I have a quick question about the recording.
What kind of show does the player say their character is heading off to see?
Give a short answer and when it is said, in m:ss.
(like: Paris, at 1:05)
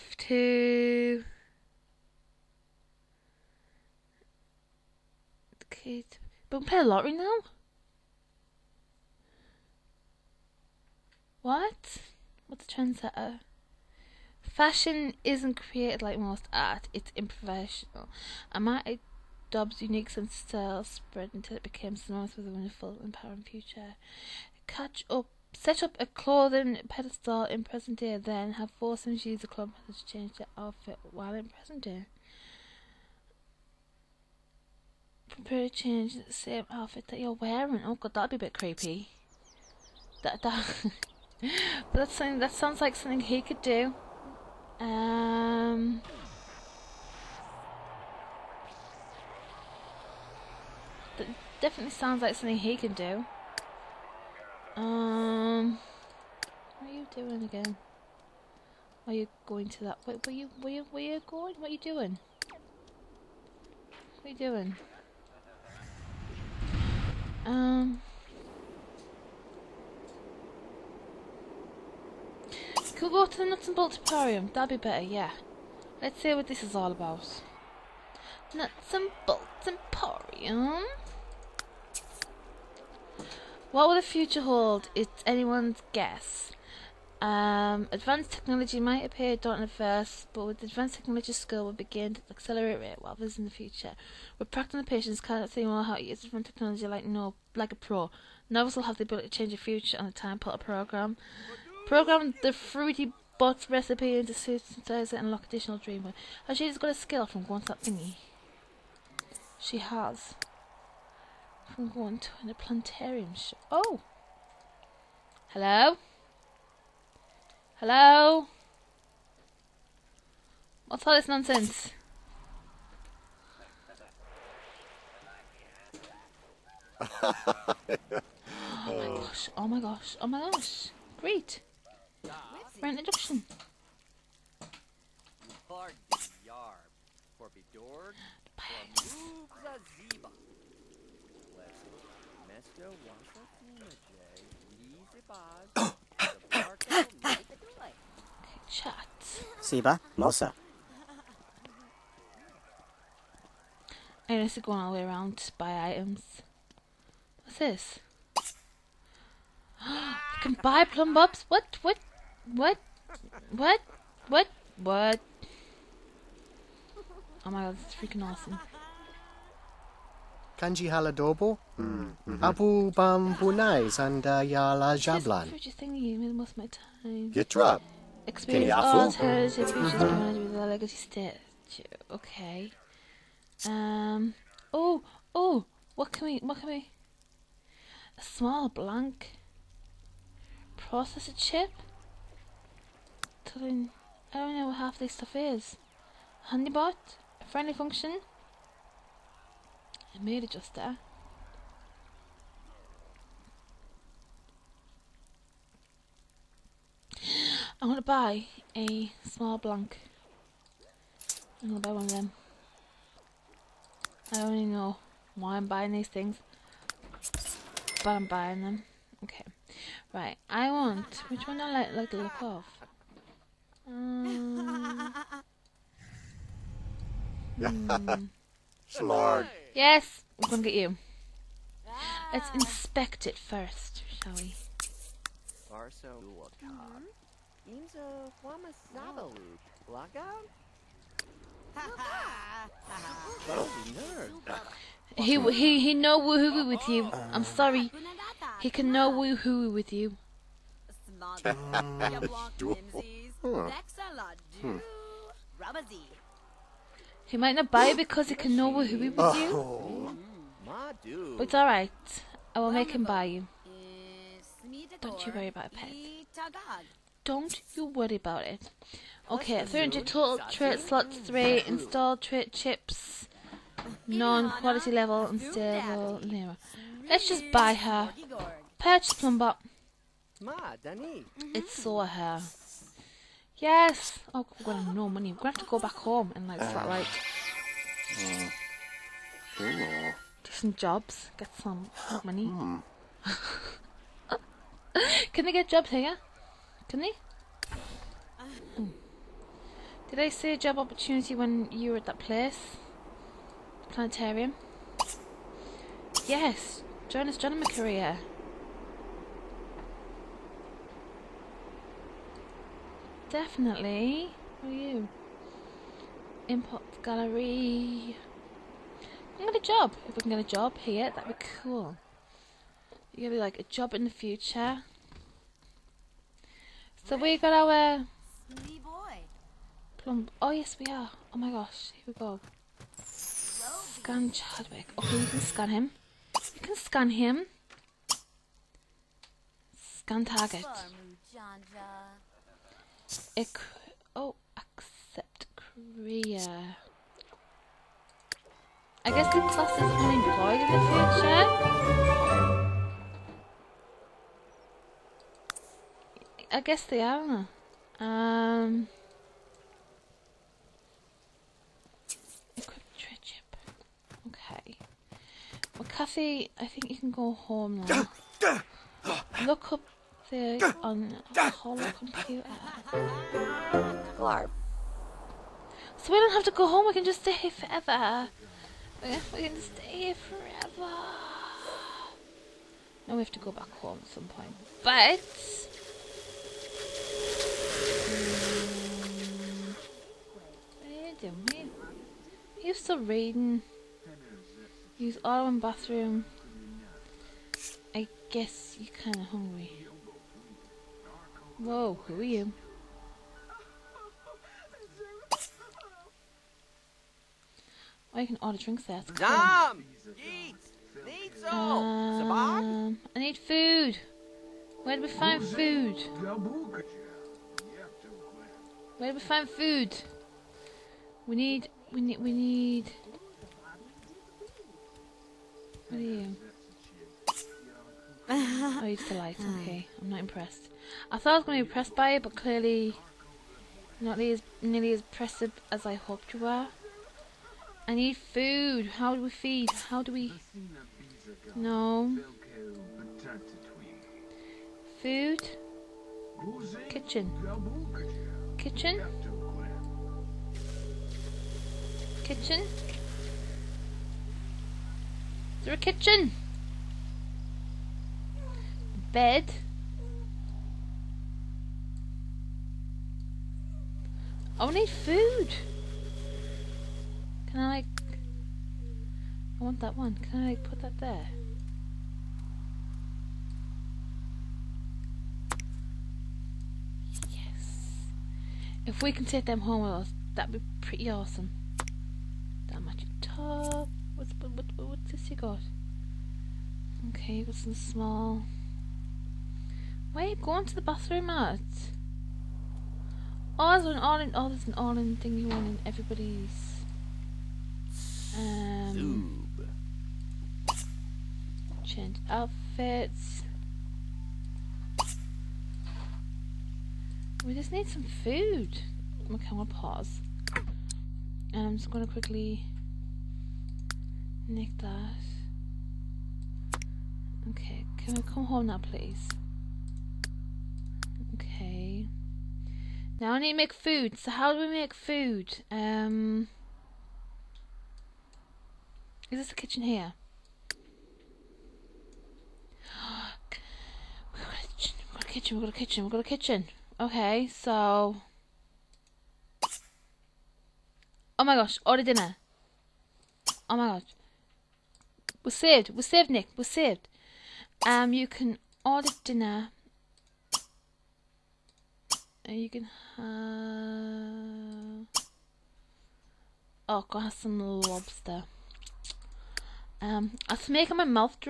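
planetarium show, at 1:52.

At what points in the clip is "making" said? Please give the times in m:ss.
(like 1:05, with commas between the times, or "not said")
9:20.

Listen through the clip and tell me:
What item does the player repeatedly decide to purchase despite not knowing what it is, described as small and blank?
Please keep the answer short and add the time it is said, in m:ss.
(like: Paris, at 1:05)
small blank processor chip, at 3:08.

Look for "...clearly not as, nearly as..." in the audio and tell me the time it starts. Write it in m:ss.
7:12.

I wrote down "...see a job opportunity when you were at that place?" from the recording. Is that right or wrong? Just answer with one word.
right.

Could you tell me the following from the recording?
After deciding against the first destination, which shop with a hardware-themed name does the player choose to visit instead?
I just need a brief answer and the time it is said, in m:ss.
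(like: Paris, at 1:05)
Nuts and Bolts Emporium, at 1:18.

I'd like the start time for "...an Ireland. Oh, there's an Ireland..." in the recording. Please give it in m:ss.
8:13.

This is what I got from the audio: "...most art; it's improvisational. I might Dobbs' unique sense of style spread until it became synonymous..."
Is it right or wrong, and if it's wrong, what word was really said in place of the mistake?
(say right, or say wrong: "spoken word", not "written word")
right.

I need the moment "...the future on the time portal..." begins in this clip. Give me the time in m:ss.
1:39.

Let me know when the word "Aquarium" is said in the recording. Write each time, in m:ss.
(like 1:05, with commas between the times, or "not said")
1:13.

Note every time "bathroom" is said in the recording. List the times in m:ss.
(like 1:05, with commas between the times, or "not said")
6:35, 8:10.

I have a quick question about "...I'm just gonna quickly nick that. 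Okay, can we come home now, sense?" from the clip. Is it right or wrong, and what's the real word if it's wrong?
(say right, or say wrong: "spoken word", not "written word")
wrong: "please", not "sense".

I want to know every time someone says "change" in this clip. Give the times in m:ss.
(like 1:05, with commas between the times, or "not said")
0:30, 0:35, 1:39, 8:21.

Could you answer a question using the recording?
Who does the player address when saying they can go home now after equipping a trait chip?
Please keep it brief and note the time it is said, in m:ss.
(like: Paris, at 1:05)
Kathy, at 6:05.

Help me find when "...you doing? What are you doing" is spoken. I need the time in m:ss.
1:01.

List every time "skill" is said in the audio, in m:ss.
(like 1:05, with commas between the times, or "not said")
1:31, 1:46.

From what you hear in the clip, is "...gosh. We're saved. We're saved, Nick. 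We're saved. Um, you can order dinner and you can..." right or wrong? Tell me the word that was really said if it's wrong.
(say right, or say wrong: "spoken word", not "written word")
right.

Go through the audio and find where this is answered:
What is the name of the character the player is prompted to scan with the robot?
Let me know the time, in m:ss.
5:33.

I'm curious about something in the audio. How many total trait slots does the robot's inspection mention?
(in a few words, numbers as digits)
300.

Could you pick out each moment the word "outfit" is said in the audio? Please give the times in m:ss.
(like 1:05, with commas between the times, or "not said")
0:30, 0:36, 8:22.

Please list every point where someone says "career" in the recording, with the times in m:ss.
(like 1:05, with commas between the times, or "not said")
5:07, 5:45.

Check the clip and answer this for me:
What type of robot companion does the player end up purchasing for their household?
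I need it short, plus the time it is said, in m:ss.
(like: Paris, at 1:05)
Plumbot, at 4:38.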